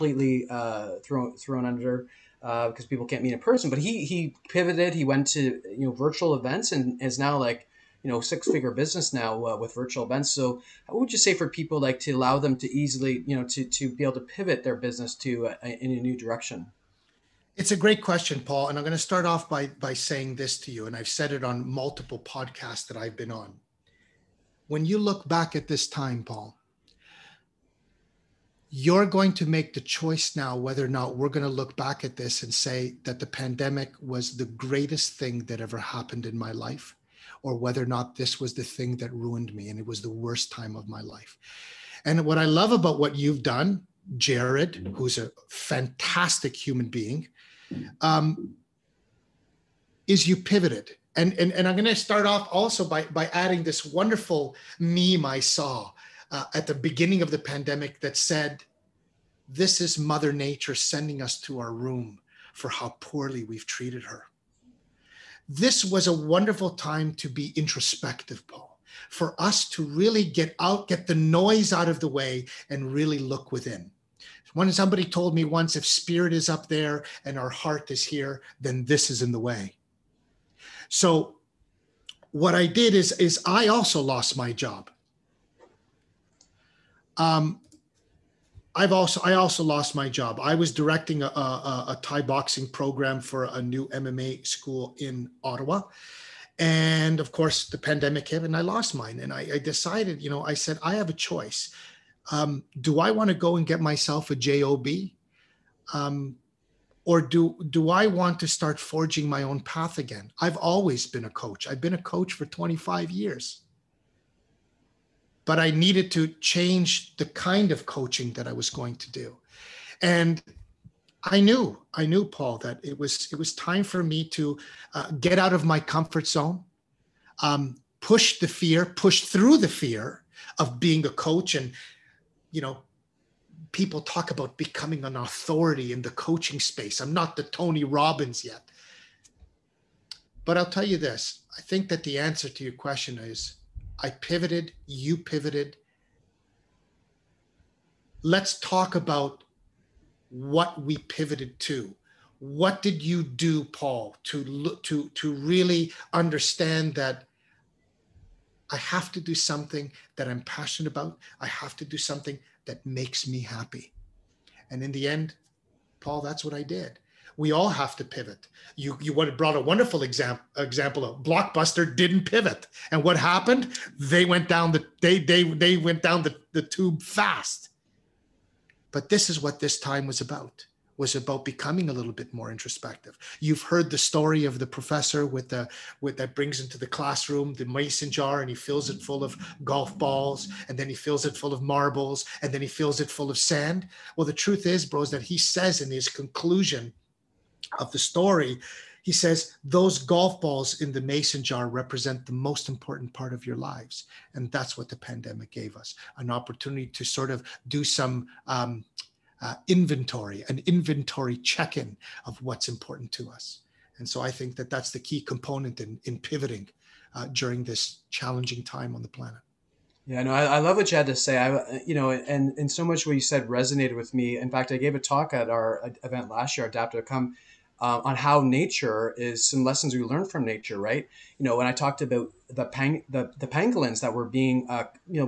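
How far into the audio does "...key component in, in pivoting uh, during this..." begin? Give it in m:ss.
3:35.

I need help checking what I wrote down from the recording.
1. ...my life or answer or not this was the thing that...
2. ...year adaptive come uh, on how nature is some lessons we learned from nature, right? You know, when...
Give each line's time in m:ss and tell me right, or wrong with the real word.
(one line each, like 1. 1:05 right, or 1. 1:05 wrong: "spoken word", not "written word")
1. 0:36 wrong: "whether", not "answer"
2. 3:46 right.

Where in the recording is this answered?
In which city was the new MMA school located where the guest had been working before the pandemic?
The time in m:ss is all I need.
1:35.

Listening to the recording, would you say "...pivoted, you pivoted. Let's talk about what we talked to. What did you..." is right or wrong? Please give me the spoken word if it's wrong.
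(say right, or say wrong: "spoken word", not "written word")
wrong: "pivoted", not "talked".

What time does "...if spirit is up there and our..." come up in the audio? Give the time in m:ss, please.
1:15.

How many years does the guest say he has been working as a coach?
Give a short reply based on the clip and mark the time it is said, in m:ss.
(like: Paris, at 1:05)
25, at 1:52.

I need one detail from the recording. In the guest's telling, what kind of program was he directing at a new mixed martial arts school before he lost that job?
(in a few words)
Thai boxing.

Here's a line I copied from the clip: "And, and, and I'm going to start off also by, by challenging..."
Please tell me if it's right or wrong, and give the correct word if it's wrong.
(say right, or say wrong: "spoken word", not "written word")
wrong: "adding", not "challenging".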